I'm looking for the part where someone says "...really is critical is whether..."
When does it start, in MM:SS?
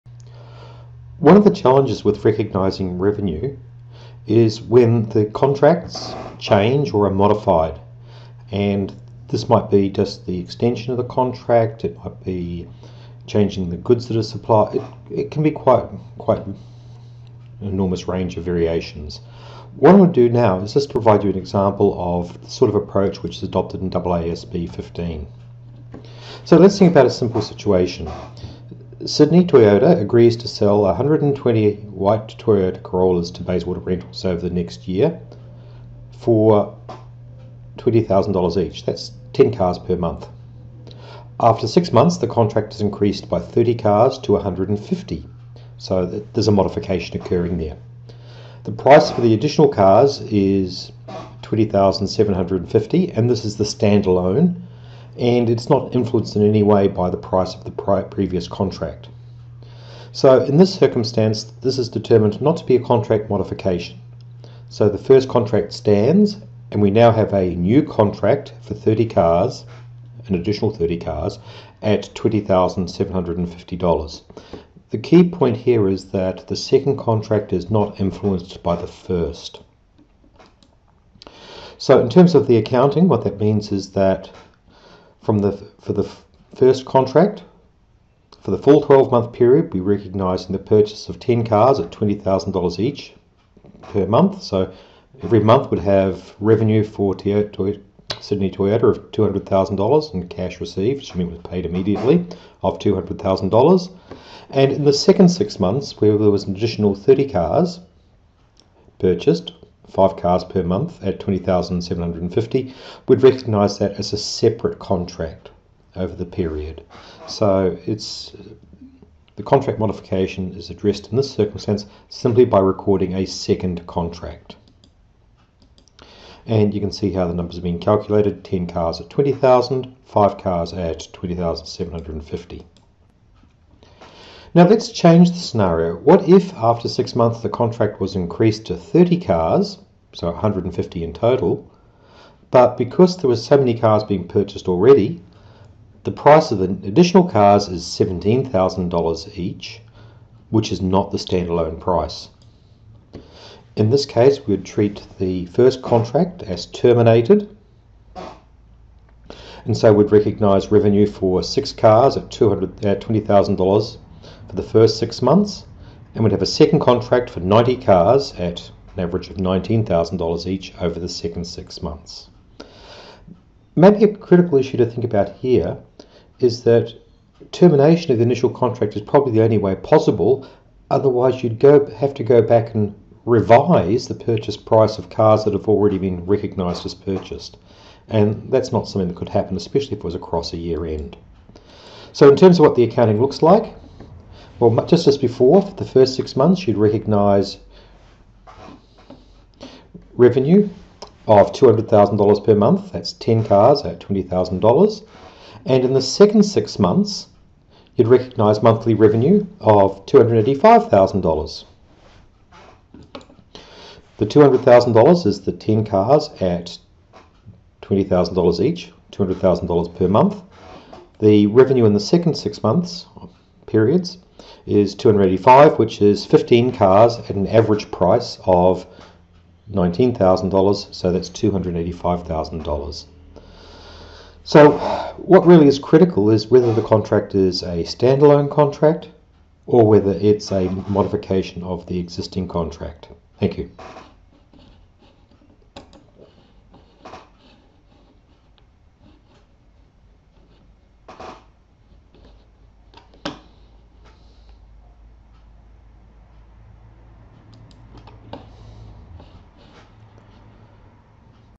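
03:55.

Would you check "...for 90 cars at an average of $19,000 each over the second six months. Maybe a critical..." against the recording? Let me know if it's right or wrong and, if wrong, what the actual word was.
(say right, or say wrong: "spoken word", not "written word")
right.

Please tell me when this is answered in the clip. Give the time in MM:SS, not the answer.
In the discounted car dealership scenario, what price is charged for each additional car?
02:27.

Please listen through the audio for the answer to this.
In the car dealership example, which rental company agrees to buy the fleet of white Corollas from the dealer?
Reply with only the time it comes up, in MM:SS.
00:33.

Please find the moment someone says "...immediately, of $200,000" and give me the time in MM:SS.
01:41.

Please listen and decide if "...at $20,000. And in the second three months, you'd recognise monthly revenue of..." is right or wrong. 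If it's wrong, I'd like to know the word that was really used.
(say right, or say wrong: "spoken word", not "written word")
wrong: "six", not "three".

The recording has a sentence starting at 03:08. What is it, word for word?
And that's not something that could happen, especially if it was across a year end.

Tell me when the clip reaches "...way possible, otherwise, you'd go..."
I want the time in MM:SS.
02:59.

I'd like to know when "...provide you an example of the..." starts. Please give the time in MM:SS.
00:20.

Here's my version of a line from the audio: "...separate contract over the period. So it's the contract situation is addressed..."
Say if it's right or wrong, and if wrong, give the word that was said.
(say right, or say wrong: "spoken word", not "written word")
wrong: "modification", not "situation".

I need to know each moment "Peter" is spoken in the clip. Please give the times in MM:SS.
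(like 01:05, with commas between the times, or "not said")
not said.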